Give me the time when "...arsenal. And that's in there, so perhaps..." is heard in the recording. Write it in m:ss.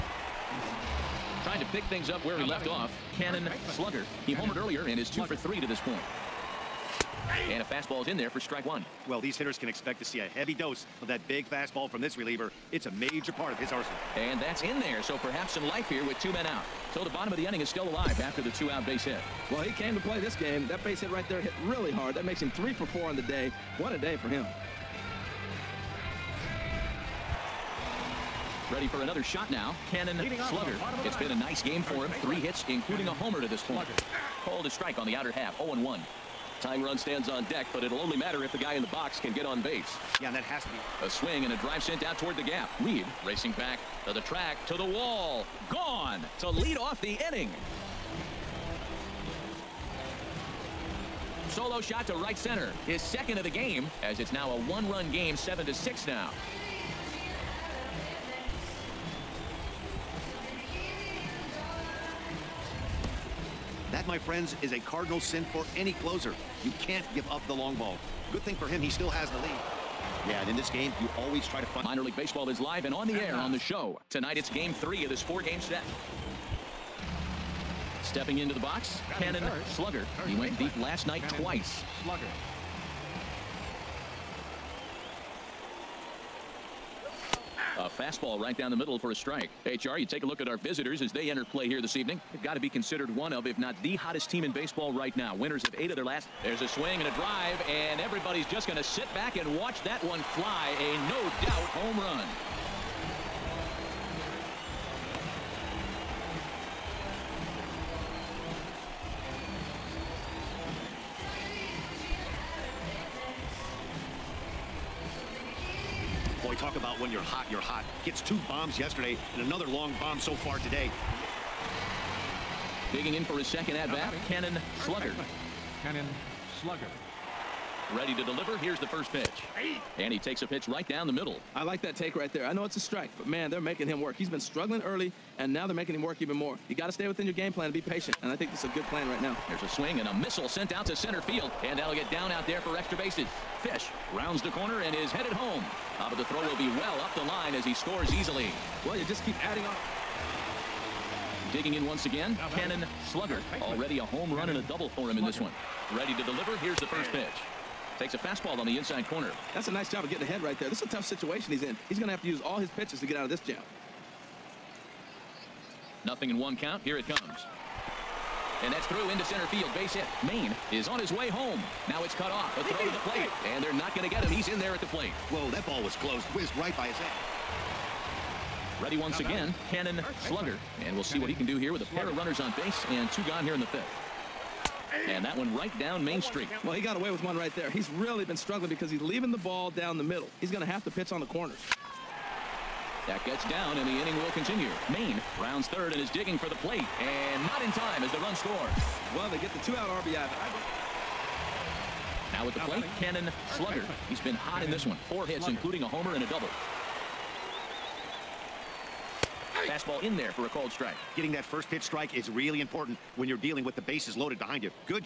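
0:13.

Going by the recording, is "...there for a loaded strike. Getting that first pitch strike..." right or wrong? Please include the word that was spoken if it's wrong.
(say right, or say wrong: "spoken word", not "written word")
wrong: "called", not "loaded".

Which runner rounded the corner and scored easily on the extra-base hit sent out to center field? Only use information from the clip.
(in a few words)
Fish.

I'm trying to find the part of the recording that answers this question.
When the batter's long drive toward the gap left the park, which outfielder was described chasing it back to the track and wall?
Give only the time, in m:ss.
0:42.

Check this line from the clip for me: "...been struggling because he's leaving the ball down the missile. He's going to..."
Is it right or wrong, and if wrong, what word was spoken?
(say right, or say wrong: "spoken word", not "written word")
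wrong: "middle", not "missile".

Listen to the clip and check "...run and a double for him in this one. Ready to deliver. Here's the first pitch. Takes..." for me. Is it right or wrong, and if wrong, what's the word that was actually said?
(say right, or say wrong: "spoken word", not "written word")
right.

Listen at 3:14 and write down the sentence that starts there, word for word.
Maine rounds third and is digging for the plate.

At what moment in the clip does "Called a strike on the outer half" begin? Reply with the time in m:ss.
0:34.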